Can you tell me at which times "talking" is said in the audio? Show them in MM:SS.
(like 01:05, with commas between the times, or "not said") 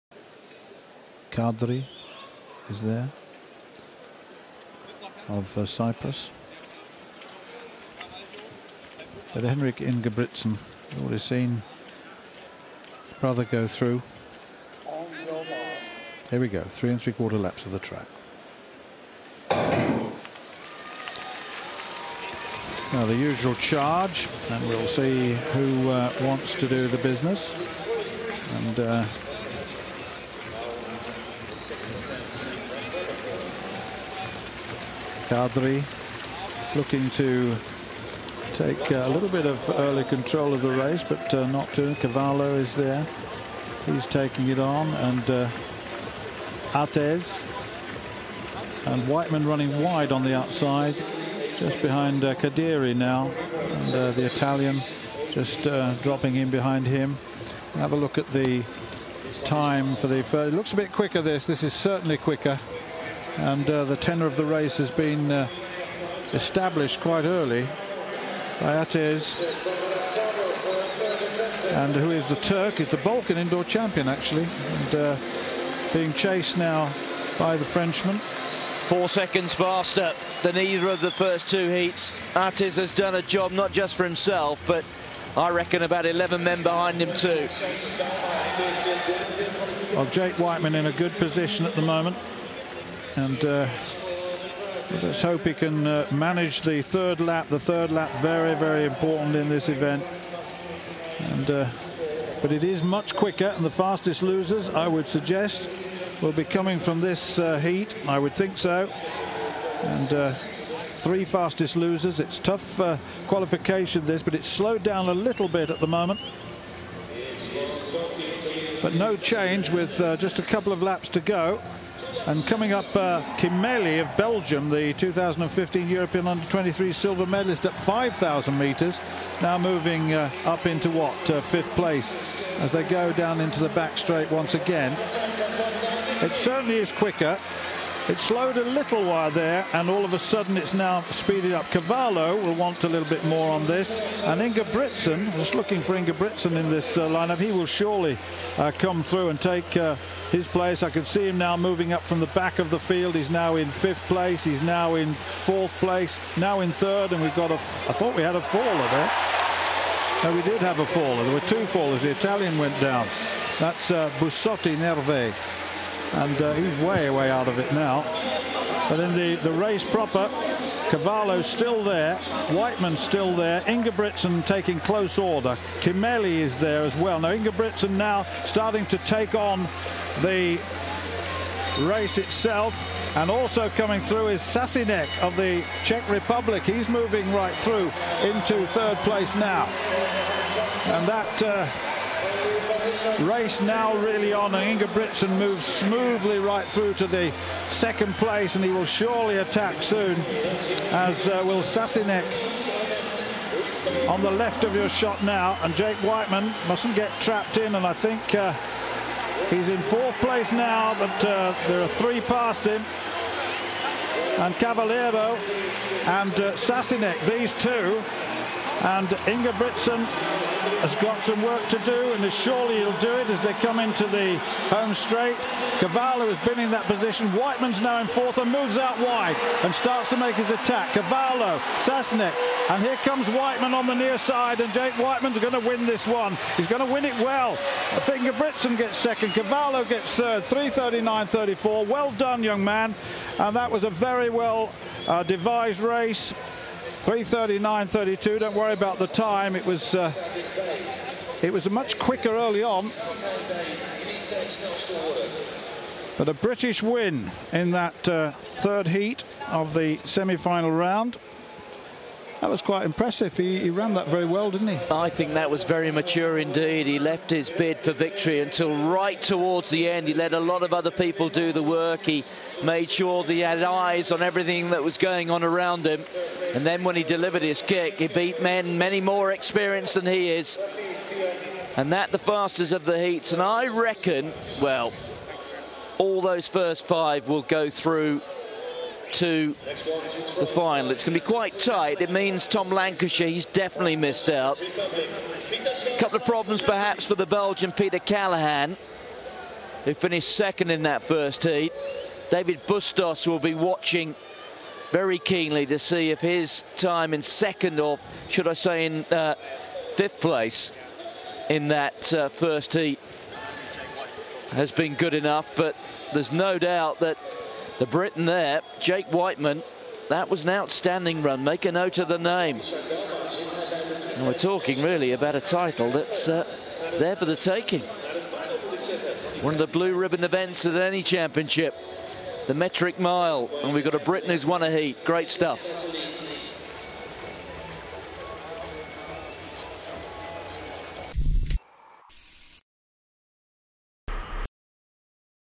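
05:24.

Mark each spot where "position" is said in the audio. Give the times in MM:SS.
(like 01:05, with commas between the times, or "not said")
01:31, 03:46.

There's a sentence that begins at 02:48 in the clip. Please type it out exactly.
But in the, the race proper, Cavallo's still there, Wightman's still there, Ingebrigtsen taking close order, Kimeli is there as well.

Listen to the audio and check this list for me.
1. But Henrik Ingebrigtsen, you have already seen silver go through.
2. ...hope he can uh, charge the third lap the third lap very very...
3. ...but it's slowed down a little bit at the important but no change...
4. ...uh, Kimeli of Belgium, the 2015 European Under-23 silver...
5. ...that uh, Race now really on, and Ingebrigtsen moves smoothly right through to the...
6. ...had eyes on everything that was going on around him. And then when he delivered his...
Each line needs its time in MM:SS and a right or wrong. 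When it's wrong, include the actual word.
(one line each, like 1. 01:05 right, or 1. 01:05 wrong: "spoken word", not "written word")
1. 00:09 wrong: "brother", not "silver"
2. 01:35 wrong: "manage", not "charge"
3. 01:54 wrong: "moment", not "important"
4. 02:02 right
5. 03:11 right
6. 04:33 right.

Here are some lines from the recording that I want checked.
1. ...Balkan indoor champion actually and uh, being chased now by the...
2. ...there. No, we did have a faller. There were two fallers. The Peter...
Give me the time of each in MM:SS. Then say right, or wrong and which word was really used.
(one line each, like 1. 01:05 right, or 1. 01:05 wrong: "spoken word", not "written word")
1. 01:12 right
2. 02:38 wrong: "Italian", not "Peter".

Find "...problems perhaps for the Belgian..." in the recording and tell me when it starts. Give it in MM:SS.
04:56.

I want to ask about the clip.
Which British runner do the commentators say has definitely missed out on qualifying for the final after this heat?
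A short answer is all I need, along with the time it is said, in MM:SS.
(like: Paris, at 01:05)
Tom Lancashire, at 04:52.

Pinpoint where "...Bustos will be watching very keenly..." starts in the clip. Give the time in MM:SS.
05:02.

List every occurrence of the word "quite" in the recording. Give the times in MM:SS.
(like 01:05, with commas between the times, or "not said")
01:06, 04:22, 04:51.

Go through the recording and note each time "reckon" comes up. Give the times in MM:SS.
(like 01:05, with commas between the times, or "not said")
01:25, 04:43.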